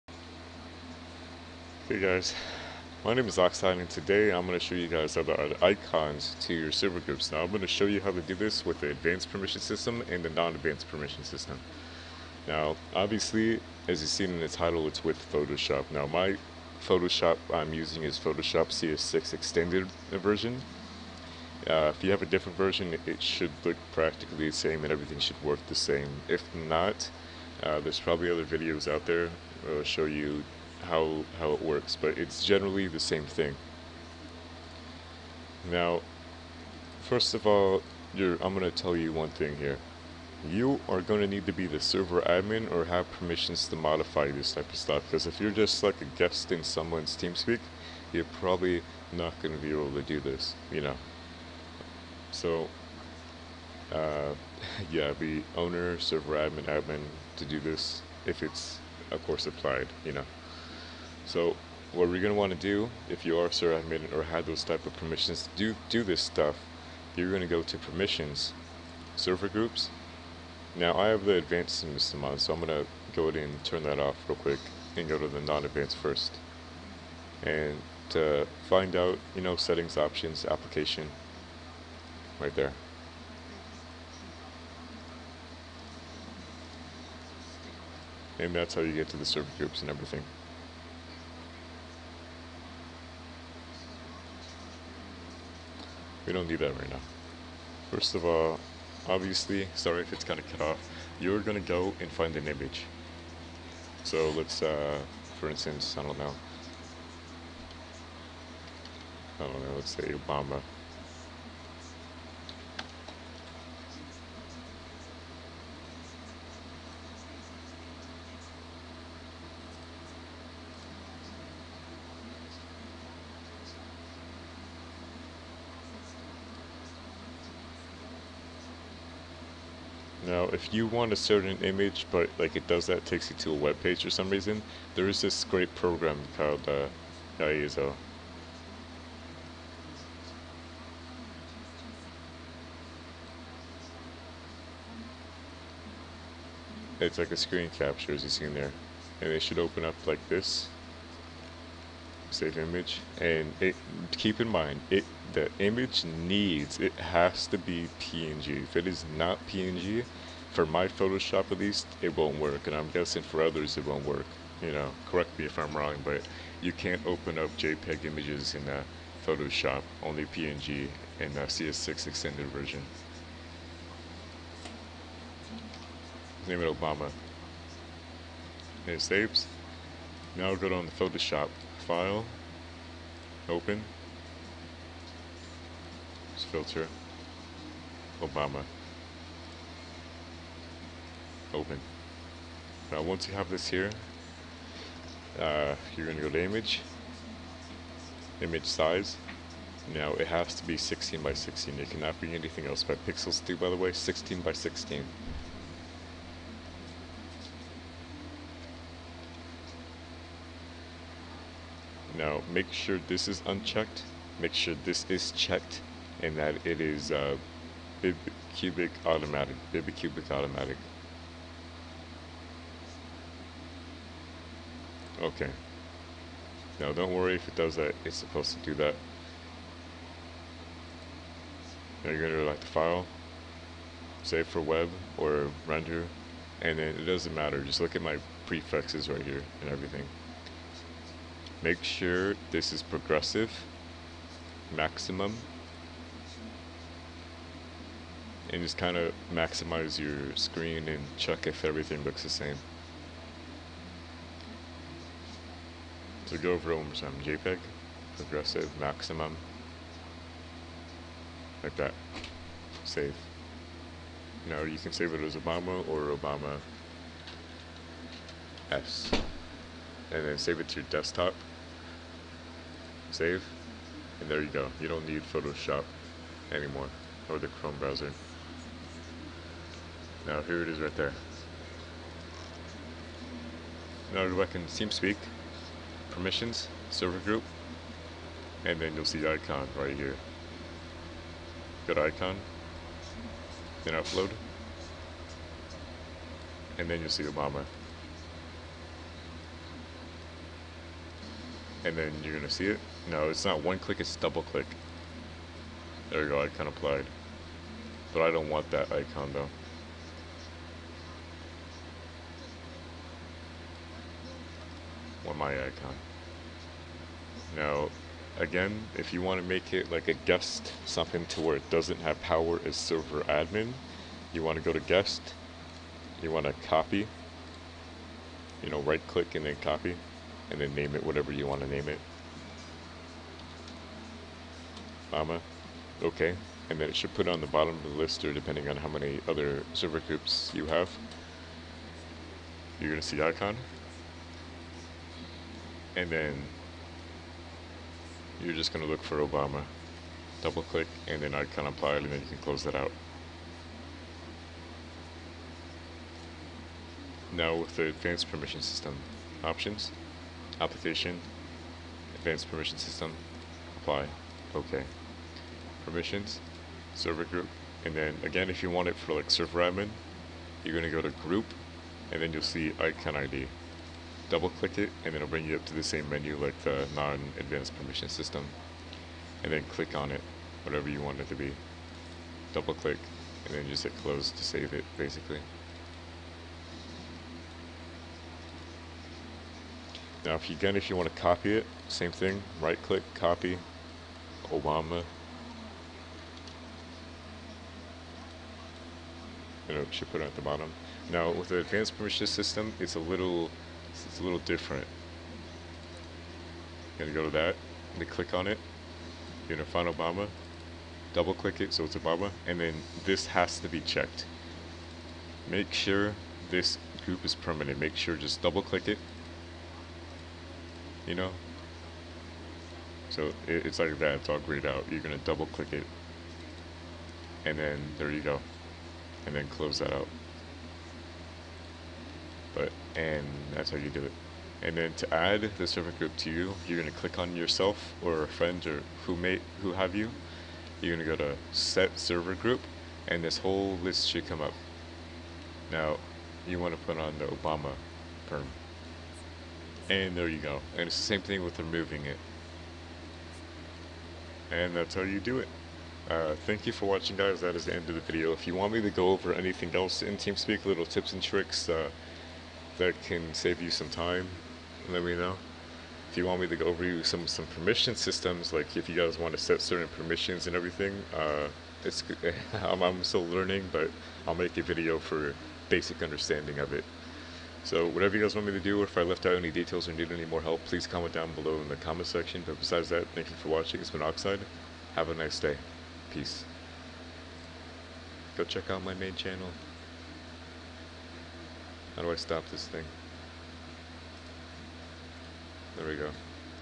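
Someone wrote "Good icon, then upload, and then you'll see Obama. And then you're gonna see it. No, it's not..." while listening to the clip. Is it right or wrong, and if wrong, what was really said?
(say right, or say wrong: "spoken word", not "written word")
right.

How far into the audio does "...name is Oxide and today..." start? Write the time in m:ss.
0:03.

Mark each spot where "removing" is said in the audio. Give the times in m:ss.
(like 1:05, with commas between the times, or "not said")
7:31.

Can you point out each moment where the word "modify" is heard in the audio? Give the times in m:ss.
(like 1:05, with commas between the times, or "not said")
0:43.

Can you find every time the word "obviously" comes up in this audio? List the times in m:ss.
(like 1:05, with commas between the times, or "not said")
0:12, 1:39.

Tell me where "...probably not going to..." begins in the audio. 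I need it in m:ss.
0:48.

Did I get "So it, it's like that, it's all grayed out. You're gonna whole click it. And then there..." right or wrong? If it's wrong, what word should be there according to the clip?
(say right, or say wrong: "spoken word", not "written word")
wrong: "double", not "whole".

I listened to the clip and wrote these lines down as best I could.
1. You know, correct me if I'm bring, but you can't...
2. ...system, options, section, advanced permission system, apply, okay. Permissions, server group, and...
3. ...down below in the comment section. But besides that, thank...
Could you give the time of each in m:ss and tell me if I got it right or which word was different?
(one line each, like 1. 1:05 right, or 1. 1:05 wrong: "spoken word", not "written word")
1. 2:44 wrong: "wrong", not "bring"
2. 5:58 wrong: "application", not "section"
3. 8:01 right.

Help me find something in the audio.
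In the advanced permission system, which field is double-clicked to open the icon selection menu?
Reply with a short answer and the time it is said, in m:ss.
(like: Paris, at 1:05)
icon ID, at 6:12.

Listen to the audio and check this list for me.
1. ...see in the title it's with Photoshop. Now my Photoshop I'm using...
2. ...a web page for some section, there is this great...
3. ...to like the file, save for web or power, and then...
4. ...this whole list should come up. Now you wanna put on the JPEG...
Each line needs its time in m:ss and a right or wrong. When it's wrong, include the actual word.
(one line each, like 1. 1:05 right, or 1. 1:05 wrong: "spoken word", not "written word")
1. 0:14 right
2. 2:13 wrong: "reason", not "section"
3. 3:52 wrong: "render", not "power"
4. 7:23 wrong: "Obama", not "JPEG".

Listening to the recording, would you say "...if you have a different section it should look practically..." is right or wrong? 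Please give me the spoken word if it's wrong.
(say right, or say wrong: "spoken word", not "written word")
wrong: "version", not "section".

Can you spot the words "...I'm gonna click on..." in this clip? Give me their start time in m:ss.
6:47.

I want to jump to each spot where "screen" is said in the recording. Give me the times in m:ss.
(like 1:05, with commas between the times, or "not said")
2:27, 4:10.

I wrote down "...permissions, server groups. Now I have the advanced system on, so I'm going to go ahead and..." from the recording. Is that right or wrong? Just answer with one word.
right.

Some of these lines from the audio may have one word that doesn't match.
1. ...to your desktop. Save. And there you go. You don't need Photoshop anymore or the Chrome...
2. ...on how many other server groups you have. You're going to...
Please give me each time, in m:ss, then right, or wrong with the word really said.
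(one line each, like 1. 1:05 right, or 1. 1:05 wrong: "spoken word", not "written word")
1. 4:30 right
2. 5:38 right.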